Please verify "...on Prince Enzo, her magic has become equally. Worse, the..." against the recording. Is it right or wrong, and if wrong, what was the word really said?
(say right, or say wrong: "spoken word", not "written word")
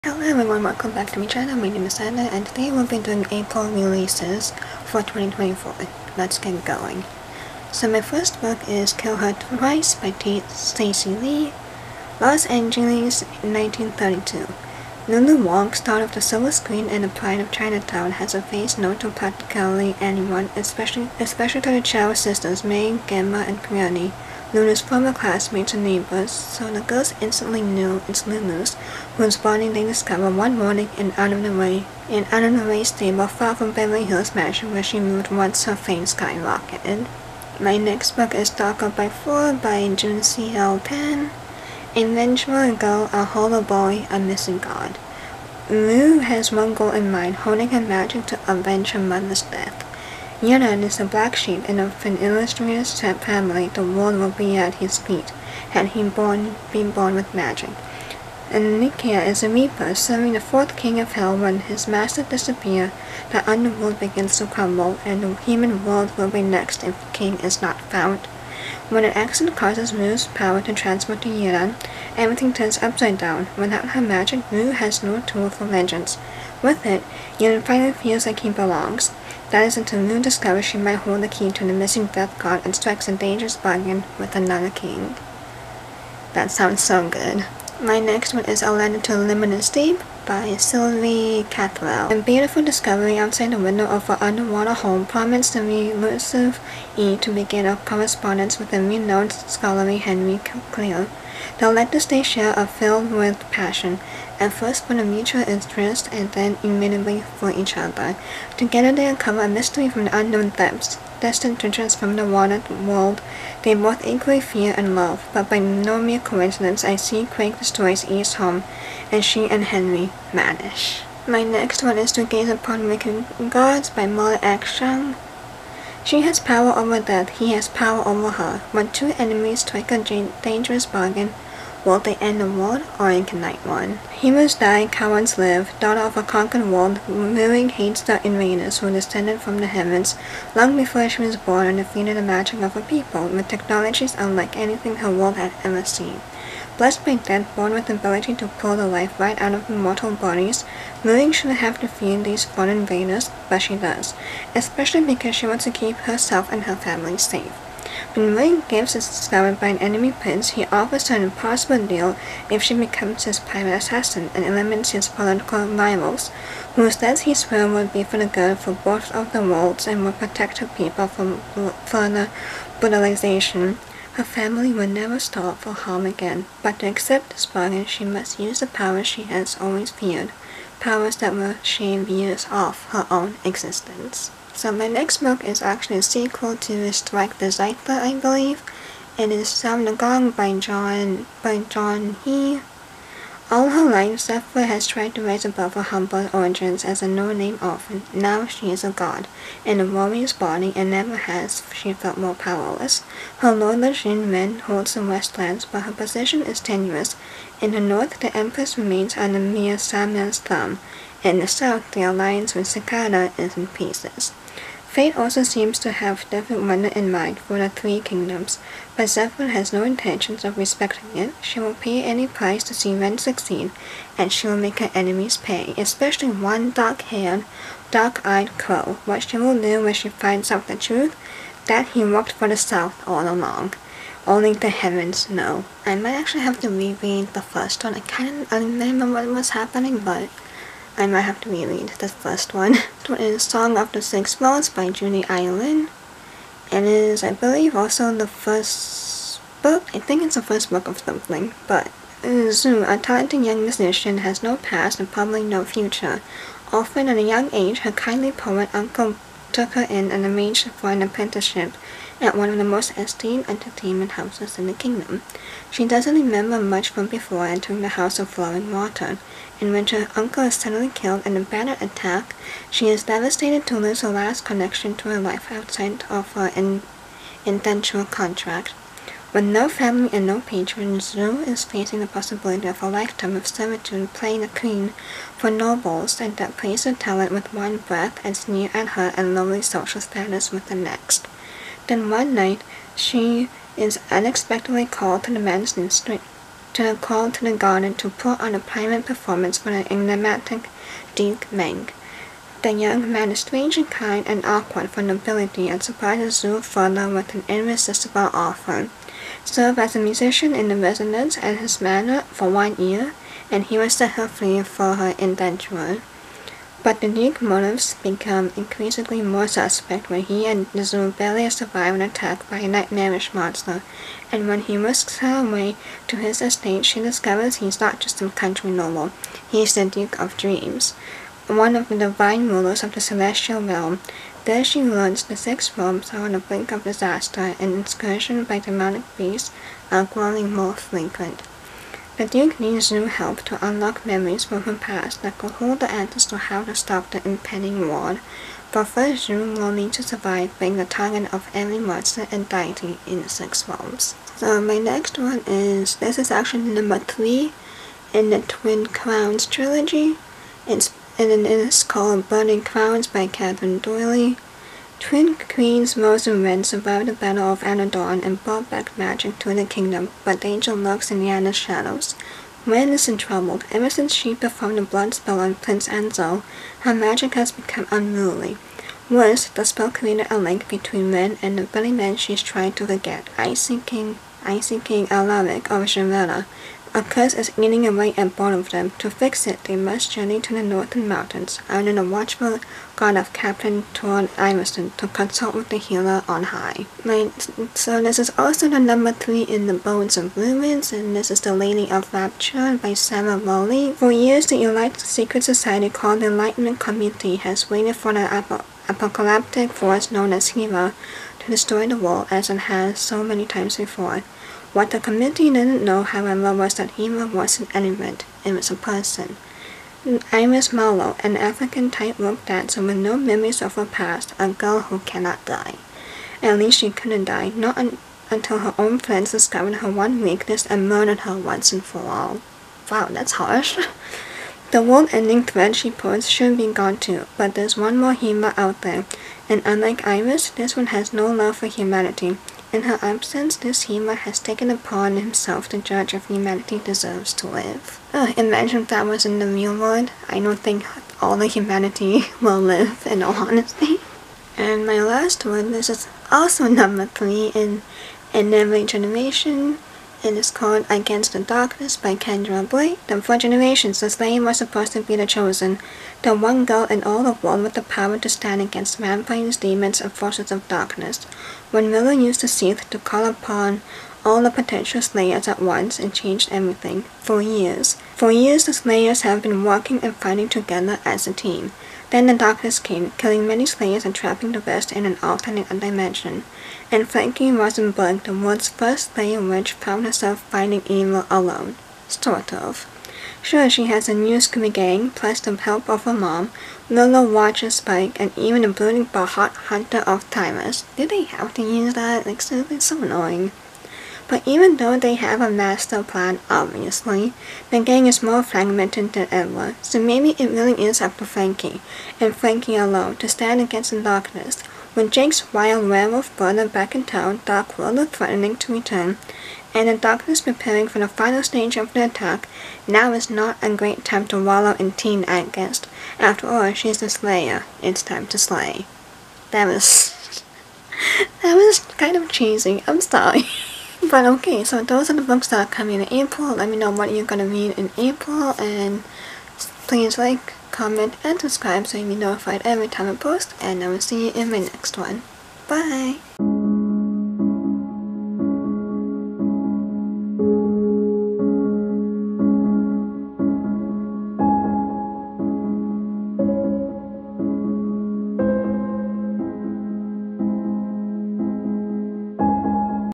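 wrong: "unruly", not "equally".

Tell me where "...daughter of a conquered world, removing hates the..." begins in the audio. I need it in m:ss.
2:15.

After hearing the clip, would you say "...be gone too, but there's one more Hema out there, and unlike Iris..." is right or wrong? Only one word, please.
right.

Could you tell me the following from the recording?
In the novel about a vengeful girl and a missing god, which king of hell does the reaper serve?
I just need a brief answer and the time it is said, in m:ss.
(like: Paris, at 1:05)
Fourth king, at 1:00.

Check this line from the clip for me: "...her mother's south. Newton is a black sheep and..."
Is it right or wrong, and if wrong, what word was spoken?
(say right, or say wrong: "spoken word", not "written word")
wrong: "death", not "south".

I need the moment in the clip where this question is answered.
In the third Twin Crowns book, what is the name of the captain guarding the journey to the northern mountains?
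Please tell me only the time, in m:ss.
6:33.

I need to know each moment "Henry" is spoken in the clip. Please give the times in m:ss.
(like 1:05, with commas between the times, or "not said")
1:39, 1:59.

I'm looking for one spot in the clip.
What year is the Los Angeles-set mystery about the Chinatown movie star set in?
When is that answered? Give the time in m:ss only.
0:13.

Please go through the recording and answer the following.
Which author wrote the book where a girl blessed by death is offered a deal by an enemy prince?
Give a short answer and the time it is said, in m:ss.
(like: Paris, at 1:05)
Molly X. Chang, at 2:04.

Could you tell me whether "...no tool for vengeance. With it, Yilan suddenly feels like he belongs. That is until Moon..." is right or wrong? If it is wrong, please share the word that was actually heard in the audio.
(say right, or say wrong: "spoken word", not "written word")
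wrong: "finally", not "suddenly".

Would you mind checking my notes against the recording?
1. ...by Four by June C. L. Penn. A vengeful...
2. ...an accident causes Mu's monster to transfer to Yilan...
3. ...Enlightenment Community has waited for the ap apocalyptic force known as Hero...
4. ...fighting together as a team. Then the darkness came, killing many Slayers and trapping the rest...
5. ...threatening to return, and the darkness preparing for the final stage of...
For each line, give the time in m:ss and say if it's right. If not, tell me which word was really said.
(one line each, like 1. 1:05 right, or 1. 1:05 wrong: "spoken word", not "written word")
1. 0:38 right
2. 1:09 wrong: "power", not "monster"
3. 6:46 right
4. 8:00 right
5. 8:38 right.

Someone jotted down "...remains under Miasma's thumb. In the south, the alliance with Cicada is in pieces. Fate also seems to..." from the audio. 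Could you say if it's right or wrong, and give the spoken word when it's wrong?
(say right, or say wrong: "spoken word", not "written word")
right.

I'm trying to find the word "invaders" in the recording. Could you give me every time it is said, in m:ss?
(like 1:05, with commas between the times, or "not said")
2:18, 2:32.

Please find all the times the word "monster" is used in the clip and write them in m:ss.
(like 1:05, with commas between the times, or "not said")
5:23, 5:51.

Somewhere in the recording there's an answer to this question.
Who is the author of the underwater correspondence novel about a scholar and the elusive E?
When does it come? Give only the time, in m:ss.
1:30.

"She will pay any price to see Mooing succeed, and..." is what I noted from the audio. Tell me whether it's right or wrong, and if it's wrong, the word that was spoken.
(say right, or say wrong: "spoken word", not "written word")
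wrong: "Ren", not "Mooing".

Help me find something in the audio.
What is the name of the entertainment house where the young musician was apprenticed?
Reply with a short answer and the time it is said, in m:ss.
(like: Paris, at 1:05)
House of Flowing Water, at 4:27.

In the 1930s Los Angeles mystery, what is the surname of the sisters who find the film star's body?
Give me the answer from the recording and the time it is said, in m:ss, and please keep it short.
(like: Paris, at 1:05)
Chow, at 0:21.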